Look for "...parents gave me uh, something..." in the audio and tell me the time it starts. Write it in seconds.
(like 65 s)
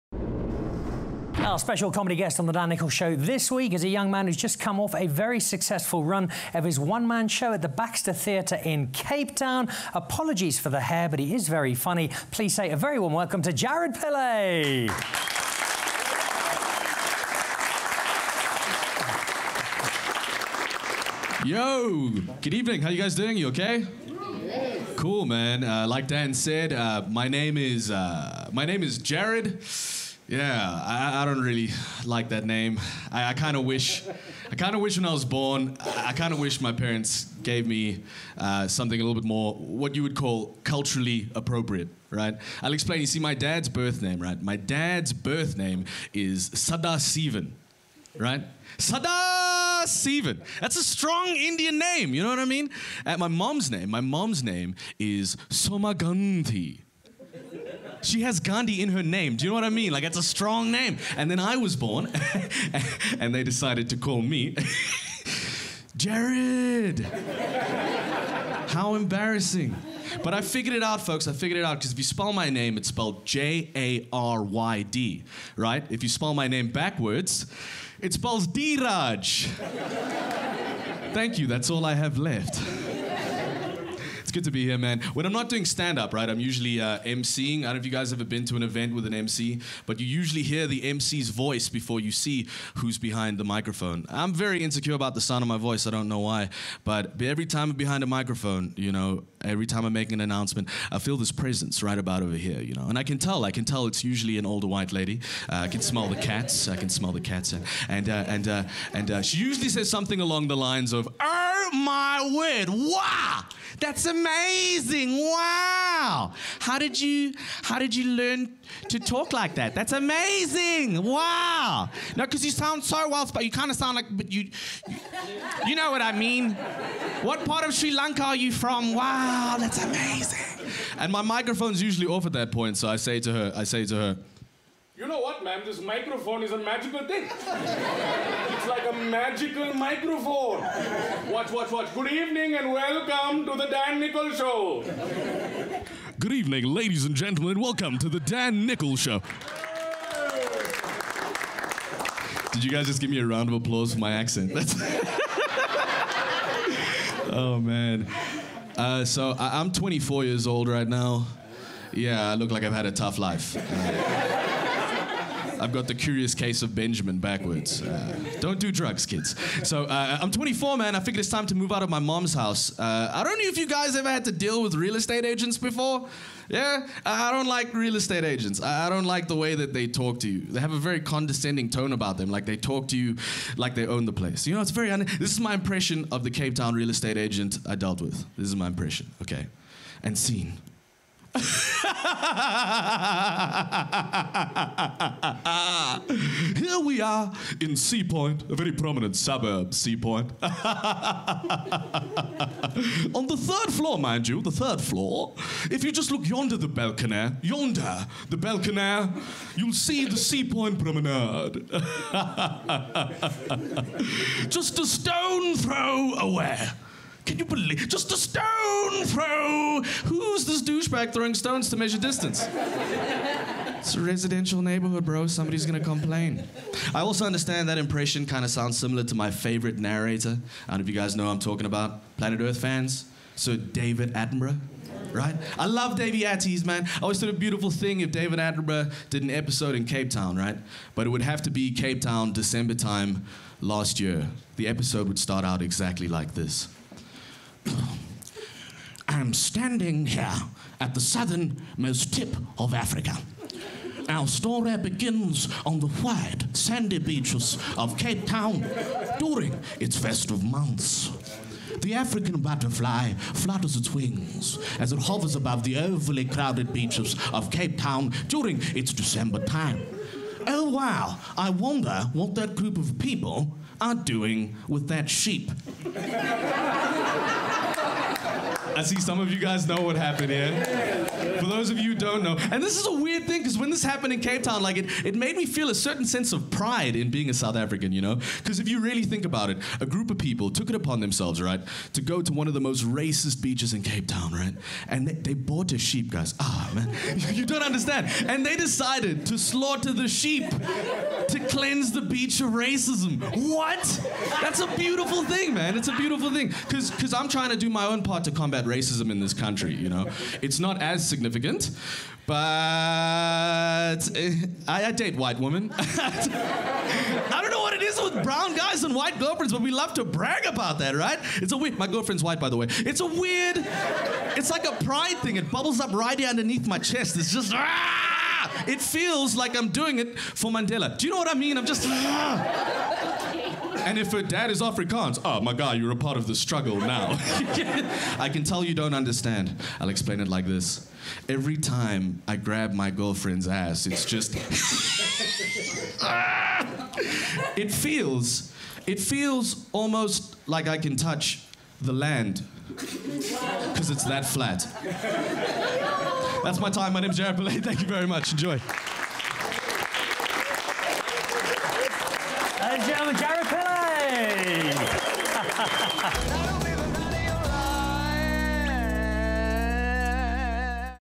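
36 s.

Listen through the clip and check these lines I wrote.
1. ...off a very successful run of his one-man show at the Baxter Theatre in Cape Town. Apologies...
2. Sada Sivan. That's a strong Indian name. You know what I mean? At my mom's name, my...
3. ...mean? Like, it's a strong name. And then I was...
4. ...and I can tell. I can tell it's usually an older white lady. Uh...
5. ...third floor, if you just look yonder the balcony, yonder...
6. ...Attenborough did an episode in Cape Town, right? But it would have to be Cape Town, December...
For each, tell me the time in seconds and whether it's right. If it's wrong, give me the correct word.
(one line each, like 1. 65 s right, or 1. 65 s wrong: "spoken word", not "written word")
1. 4 s right
2. 48 s right
3. 59 s right
4. 102 s right
5. 204 s right
6. 238 s right.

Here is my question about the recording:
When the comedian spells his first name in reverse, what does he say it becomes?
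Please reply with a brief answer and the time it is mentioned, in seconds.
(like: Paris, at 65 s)
D Raj, at 78 s.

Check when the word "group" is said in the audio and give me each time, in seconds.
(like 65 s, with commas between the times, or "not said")
272 s, 289 s.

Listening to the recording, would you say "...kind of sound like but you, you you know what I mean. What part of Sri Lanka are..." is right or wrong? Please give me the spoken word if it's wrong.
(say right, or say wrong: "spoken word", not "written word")
right.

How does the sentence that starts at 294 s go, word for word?
And they, they bought a sheep, guys.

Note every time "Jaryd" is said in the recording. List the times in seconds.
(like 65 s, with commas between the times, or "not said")
13 s, 65 s, 357 s.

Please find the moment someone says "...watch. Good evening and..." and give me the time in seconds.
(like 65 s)
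141 s.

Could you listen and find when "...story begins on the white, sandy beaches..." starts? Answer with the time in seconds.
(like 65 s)
254 s.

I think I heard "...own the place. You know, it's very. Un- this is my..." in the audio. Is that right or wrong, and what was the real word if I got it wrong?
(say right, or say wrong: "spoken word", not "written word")
right.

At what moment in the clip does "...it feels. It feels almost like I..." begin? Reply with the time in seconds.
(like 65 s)
347 s.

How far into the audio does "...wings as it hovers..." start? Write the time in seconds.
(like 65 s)
263 s.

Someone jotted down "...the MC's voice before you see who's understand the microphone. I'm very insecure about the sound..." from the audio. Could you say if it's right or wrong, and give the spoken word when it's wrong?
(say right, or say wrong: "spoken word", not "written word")
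wrong: "behind", not "understand".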